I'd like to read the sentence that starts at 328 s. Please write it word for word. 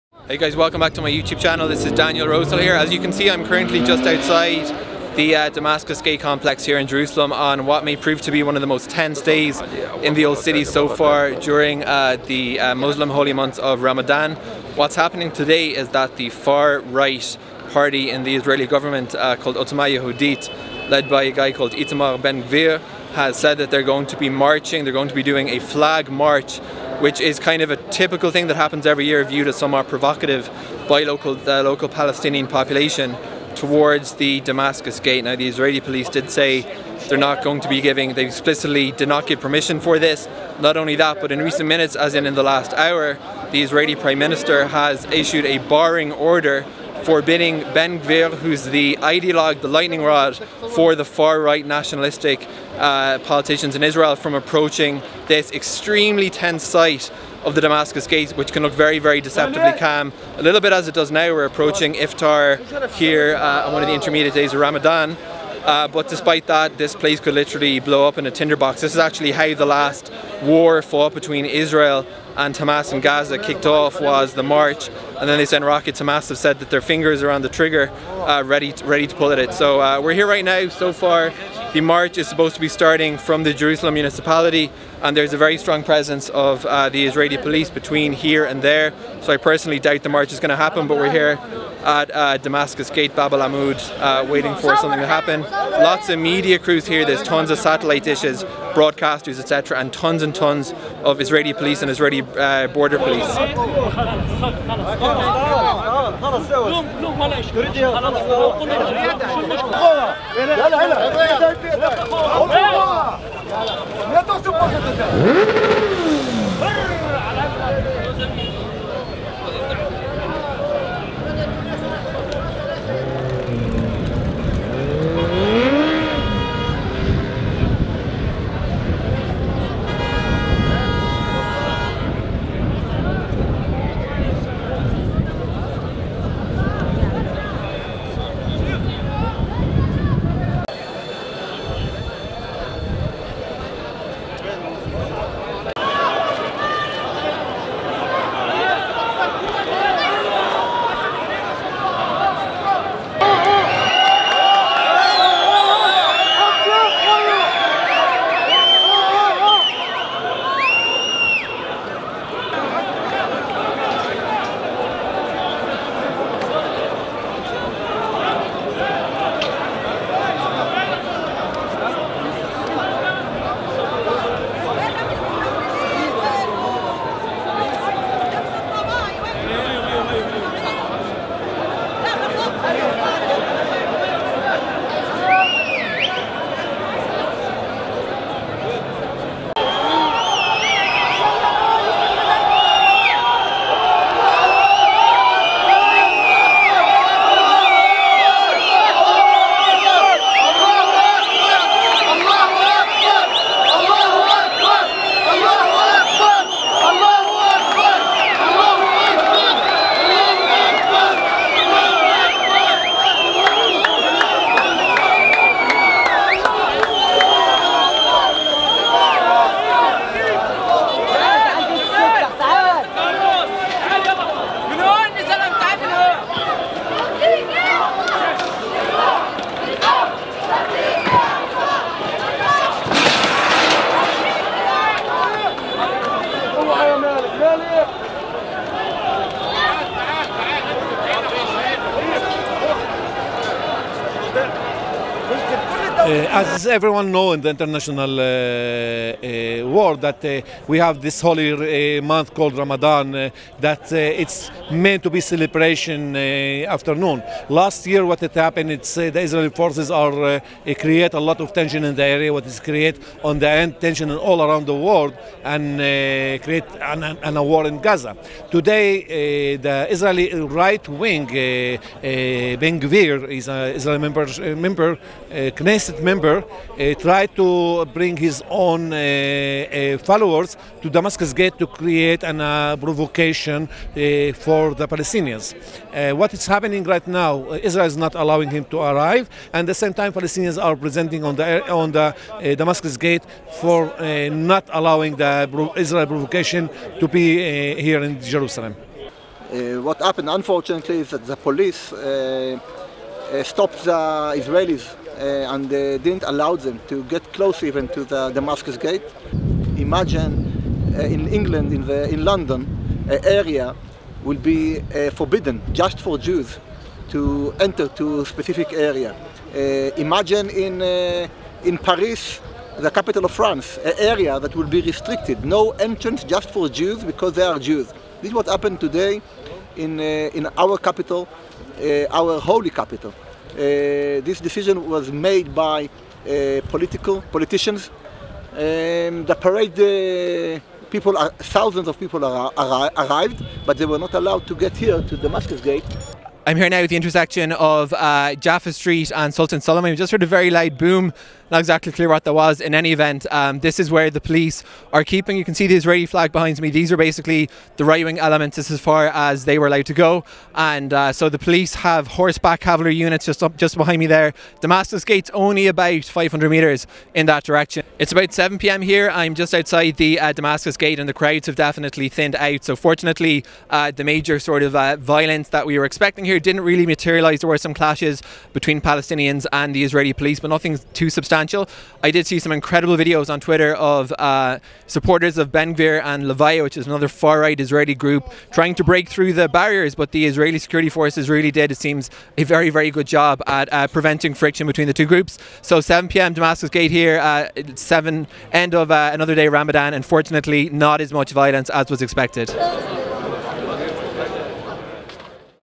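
This is what happened today in, uh, in our capital, uh, our holy capital.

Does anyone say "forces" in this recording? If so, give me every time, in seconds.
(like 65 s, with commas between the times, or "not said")
259 s, 390 s.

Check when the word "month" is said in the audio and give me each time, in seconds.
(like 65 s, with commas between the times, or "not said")
13 s, 252 s.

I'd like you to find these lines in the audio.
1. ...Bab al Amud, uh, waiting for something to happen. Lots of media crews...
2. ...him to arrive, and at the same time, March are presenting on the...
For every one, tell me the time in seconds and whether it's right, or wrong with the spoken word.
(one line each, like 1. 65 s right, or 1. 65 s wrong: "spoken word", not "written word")
1. 93 s right
2. 288 s wrong: "Palestinians", not "March".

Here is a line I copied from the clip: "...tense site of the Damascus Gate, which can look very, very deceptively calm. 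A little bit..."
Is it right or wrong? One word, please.
right.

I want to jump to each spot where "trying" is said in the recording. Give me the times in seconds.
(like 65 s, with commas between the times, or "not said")
388 s.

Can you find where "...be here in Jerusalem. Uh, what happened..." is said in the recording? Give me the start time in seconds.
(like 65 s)
297 s.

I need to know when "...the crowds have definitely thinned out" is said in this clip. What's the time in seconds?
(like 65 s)
371 s.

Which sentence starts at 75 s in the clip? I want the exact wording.
Hamas have said that their fingers are on the trigger, uh, ready to, ready to pull at it.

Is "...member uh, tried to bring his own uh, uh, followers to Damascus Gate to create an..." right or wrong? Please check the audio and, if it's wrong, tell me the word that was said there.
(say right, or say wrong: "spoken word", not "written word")
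right.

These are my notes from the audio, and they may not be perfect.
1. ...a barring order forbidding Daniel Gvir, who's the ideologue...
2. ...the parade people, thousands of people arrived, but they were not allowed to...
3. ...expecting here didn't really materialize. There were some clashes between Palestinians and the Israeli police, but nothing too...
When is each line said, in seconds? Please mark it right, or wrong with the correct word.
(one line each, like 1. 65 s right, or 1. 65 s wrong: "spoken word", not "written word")
1. 45 s wrong: "Ben", not "Daniel"
2. 339 s right
3. 375 s right.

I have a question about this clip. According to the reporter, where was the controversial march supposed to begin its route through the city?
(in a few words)
Jerusalem municipality.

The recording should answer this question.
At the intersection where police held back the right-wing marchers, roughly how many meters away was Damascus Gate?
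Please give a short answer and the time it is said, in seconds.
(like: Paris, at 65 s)
500 meters, at 366 s.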